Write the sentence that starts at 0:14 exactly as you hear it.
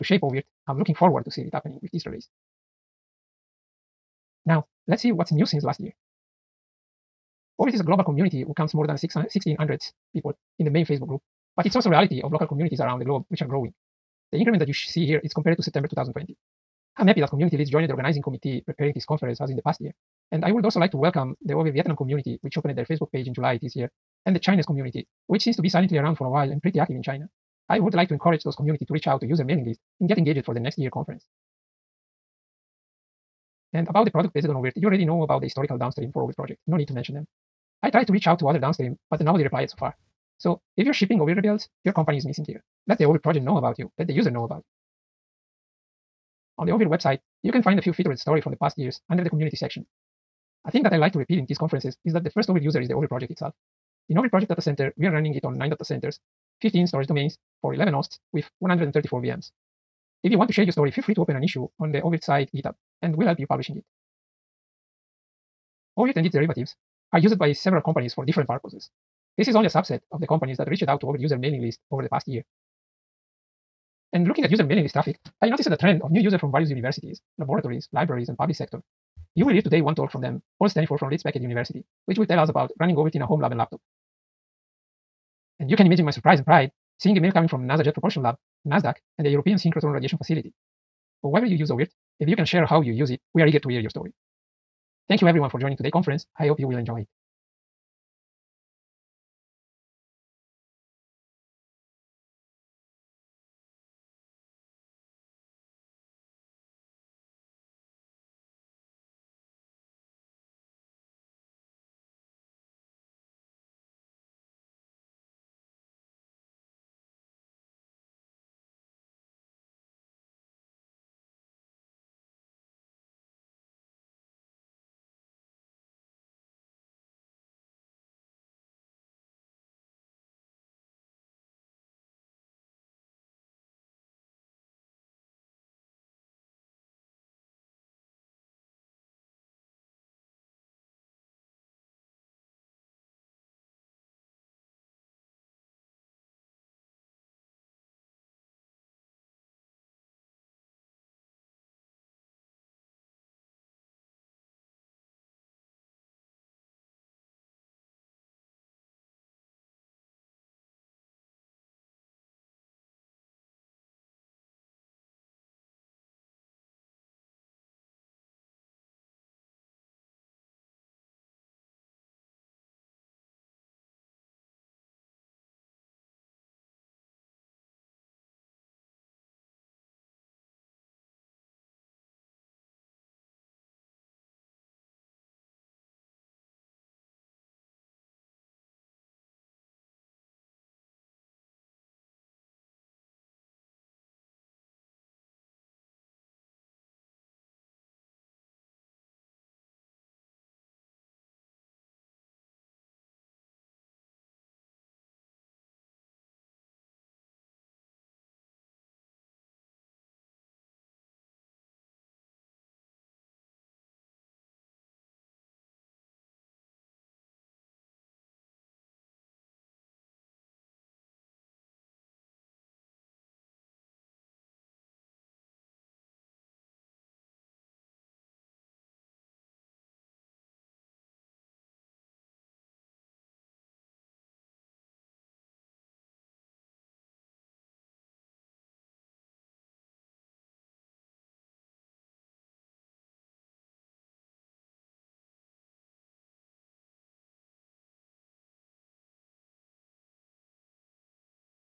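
The increment that you see here is compared to September 2020.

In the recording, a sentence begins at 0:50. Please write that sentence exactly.
A thing that I like to repeat in these conferences is that the first oVirt user is the oVirt project itself.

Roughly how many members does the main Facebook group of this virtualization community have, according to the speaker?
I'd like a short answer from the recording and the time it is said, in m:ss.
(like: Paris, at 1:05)
more than 1600, at 0:08.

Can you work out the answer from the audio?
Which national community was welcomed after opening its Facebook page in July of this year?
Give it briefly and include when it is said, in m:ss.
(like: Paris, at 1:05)
Vietnam, at 0:21.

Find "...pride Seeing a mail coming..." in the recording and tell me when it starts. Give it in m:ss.
1:26.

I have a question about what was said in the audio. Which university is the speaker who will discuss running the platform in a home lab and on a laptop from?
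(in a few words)
Leeds Beckett University.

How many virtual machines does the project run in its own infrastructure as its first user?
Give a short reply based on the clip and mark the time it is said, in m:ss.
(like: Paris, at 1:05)
134, at 0:58.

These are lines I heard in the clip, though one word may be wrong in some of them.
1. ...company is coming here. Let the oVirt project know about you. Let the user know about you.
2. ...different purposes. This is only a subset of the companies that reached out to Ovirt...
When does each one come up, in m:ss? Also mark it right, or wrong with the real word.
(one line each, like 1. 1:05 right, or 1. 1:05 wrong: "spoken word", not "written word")
1. 0:41 wrong: "missing", not "coming"
2. 1:08 right.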